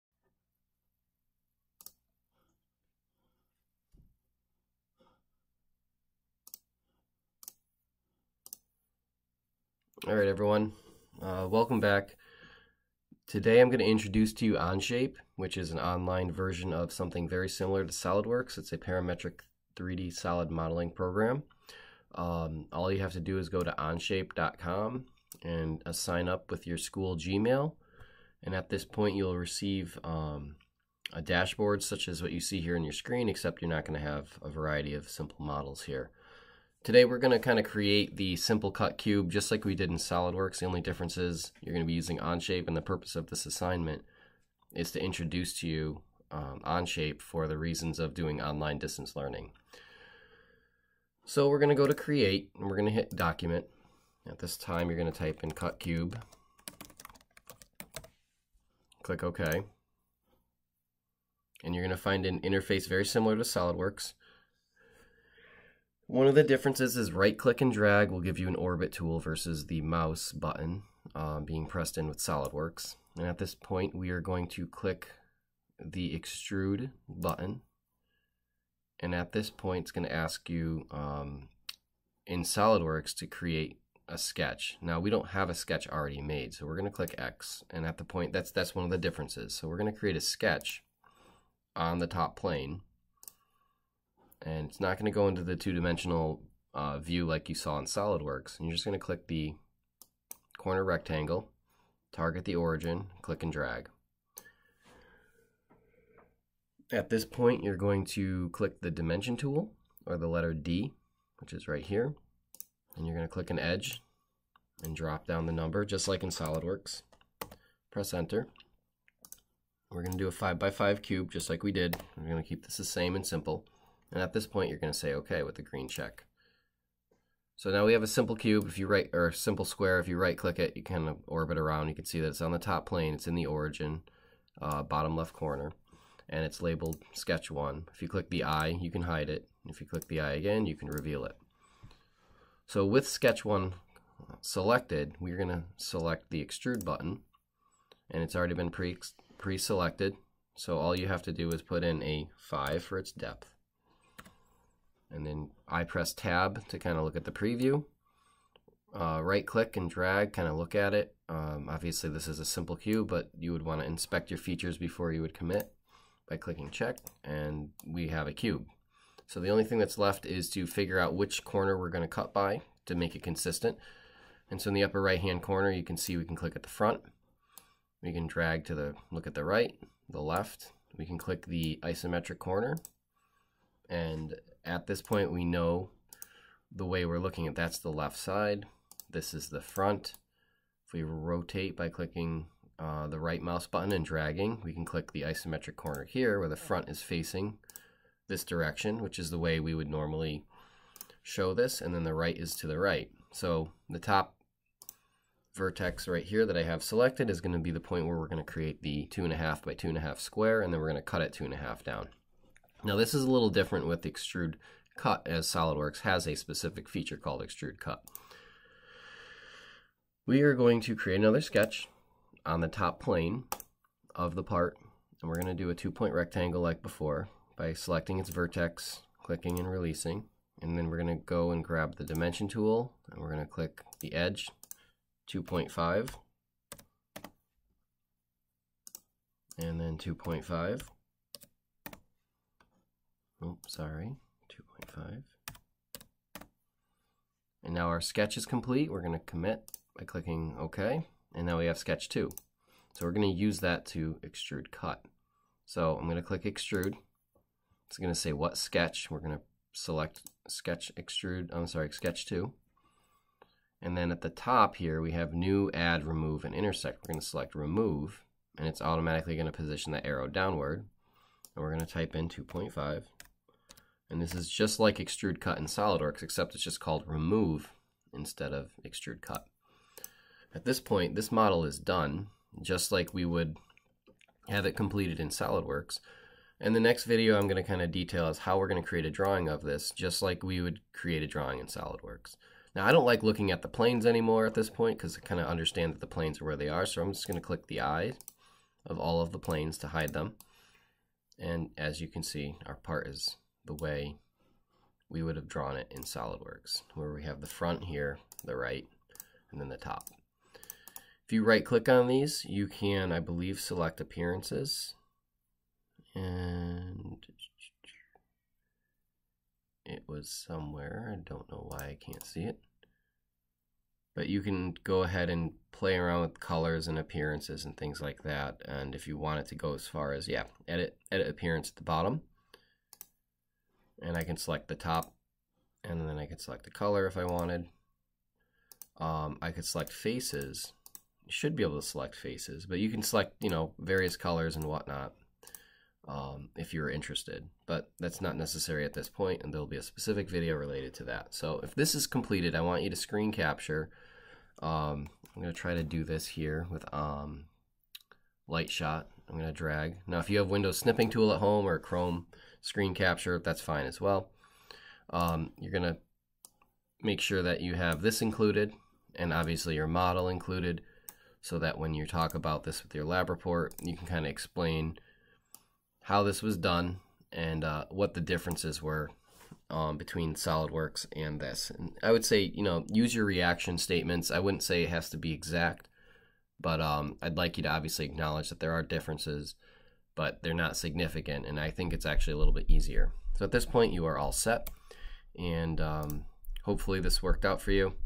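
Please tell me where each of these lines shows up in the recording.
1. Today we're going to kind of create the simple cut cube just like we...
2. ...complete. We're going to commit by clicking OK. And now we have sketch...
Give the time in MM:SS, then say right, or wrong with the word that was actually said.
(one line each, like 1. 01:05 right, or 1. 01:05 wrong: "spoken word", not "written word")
1. 00:36 right
2. 04:08 right.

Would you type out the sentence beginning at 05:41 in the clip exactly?
should be able to select faces, but you can select, you know, various colors and whatnot um, if you're interested.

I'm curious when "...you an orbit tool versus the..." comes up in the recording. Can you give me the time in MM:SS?
01:08.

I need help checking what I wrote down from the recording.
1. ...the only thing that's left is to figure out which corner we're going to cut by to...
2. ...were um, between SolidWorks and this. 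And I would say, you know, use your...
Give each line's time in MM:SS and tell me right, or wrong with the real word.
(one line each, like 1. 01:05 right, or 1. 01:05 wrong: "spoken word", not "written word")
1. 02:49 right
2. 06:18 right.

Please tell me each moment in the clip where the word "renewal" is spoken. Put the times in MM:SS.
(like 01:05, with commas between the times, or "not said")
not said.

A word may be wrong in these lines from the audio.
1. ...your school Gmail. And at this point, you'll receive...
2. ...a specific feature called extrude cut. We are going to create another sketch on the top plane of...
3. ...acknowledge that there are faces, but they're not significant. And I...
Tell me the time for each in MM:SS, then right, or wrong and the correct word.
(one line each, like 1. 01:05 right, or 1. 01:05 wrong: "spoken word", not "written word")
1. 00:26 right
2. 03:36 right
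3. 06:28 wrong: "differences", not "faces".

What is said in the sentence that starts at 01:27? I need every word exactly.
And at the point, that's that's one of the differences.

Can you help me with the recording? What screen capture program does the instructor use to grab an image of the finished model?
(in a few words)
Light Shot.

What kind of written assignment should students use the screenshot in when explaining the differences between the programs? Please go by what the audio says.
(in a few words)
lab report.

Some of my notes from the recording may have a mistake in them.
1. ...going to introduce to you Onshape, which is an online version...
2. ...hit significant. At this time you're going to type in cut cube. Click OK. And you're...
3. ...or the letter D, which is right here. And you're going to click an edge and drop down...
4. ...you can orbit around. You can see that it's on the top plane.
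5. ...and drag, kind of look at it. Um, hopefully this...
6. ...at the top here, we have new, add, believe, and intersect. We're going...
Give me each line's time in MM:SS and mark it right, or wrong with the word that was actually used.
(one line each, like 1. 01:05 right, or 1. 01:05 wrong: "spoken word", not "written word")
1. 00:13 right
2. 00:52 wrong: "document", not "significant"
3. 01:50 right
4. 02:10 right
5. 02:39 wrong: "obviously", not "hopefully"
6. 04:24 wrong: "remove", not "believe".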